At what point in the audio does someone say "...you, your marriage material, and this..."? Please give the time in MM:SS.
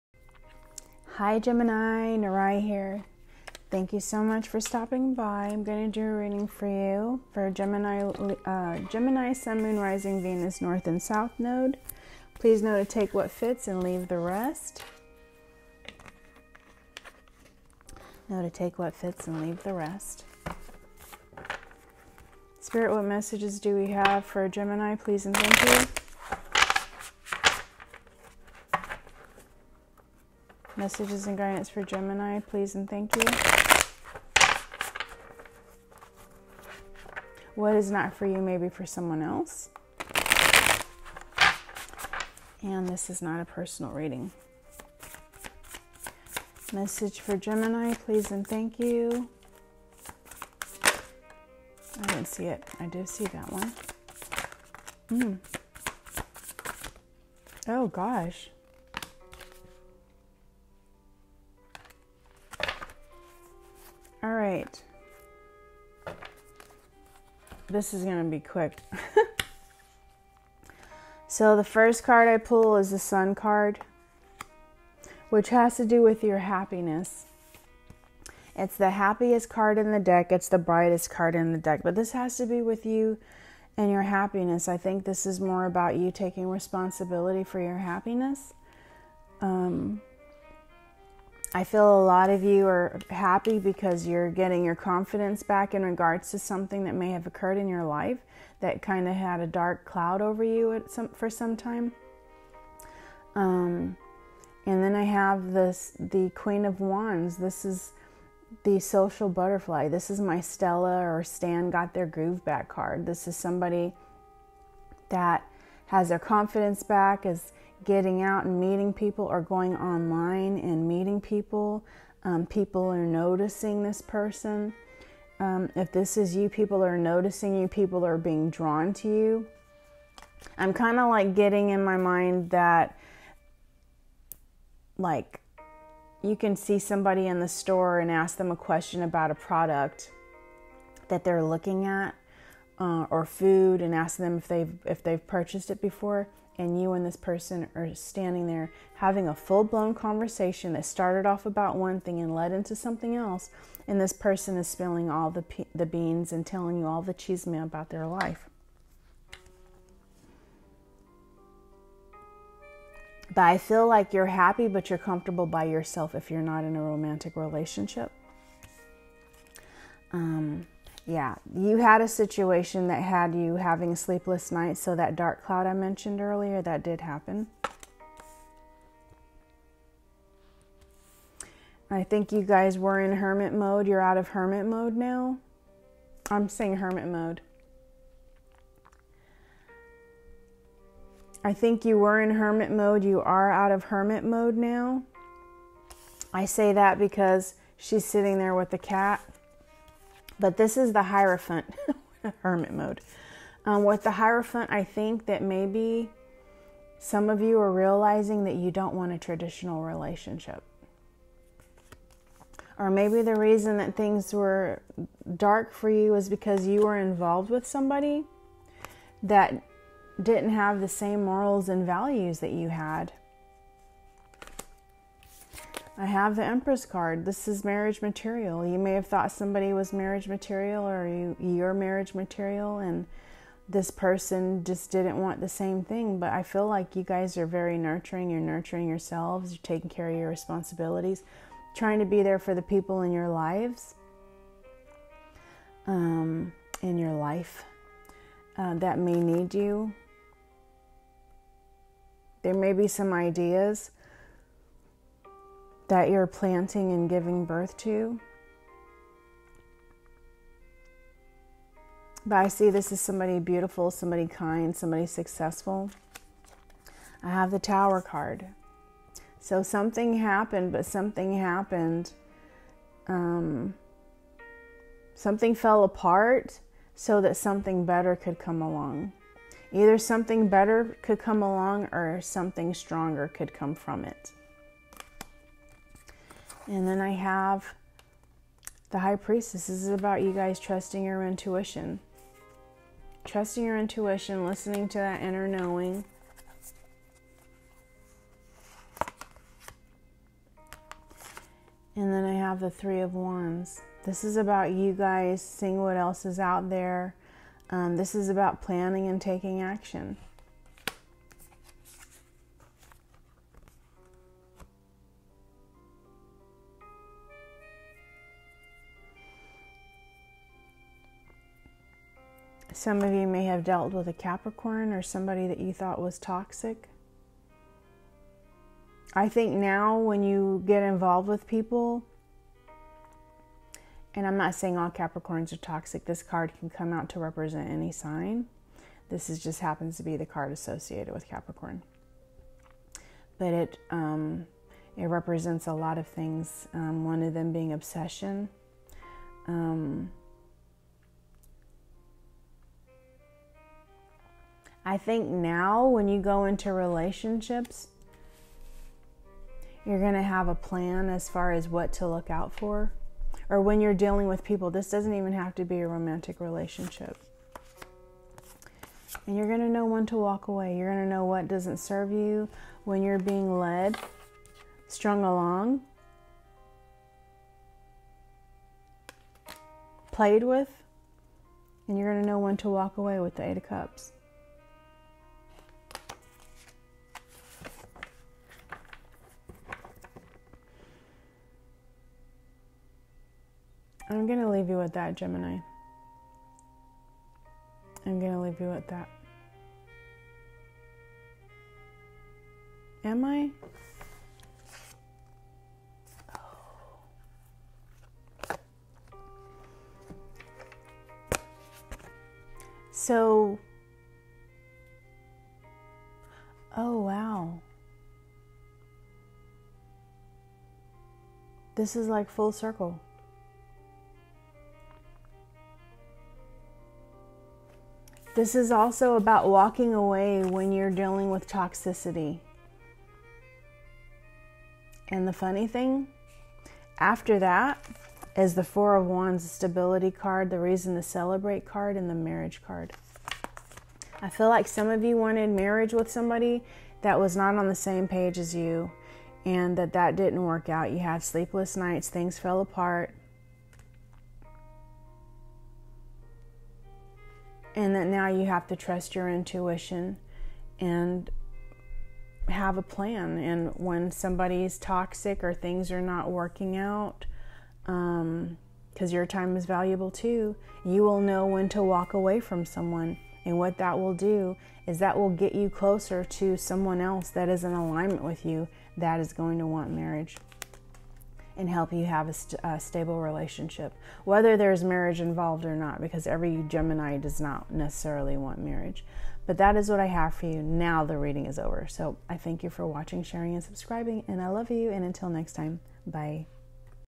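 03:51.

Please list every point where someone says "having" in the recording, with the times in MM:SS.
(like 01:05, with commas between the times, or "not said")
02:28, 02:53.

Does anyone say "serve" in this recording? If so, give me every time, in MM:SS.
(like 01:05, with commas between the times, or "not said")
06:11.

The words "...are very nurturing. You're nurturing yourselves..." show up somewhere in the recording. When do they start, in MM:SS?
03:57.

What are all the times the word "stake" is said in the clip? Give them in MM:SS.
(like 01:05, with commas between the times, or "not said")
not said.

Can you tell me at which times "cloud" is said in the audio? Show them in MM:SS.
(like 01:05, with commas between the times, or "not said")
01:39, 02:55.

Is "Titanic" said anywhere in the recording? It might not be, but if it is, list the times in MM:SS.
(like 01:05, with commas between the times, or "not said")
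not said.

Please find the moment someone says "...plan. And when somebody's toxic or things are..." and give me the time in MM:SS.
07:42.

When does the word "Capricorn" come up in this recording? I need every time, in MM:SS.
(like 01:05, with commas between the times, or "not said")
05:24, 05:34, 05:41.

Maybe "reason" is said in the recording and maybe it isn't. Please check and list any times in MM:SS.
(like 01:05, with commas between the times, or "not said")
03:33, 07:20.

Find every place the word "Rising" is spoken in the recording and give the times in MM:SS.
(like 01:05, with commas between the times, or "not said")
00:09.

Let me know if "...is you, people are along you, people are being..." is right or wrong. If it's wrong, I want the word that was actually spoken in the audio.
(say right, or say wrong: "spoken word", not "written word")
wrong: "noticing", not "along".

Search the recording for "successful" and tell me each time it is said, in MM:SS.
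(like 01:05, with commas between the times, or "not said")
04:25.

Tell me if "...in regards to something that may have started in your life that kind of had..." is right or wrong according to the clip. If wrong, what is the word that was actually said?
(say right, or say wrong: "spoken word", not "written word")
wrong: "occurred", not "started".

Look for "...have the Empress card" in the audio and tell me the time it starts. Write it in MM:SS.
03:46.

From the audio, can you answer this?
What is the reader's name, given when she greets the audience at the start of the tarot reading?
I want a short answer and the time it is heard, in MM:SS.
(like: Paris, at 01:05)
Narai, at 00:02.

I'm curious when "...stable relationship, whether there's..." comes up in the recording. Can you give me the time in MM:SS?
08:02.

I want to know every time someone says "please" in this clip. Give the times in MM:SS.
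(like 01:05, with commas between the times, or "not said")
00:12, 00:24, 00:32, 00:47.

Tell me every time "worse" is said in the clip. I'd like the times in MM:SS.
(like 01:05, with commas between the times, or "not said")
not said.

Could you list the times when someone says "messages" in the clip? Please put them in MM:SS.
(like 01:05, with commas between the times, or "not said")
00:23, 00:30, 00:46.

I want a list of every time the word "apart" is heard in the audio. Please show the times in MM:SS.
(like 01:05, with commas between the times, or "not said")
04:35, 07:32.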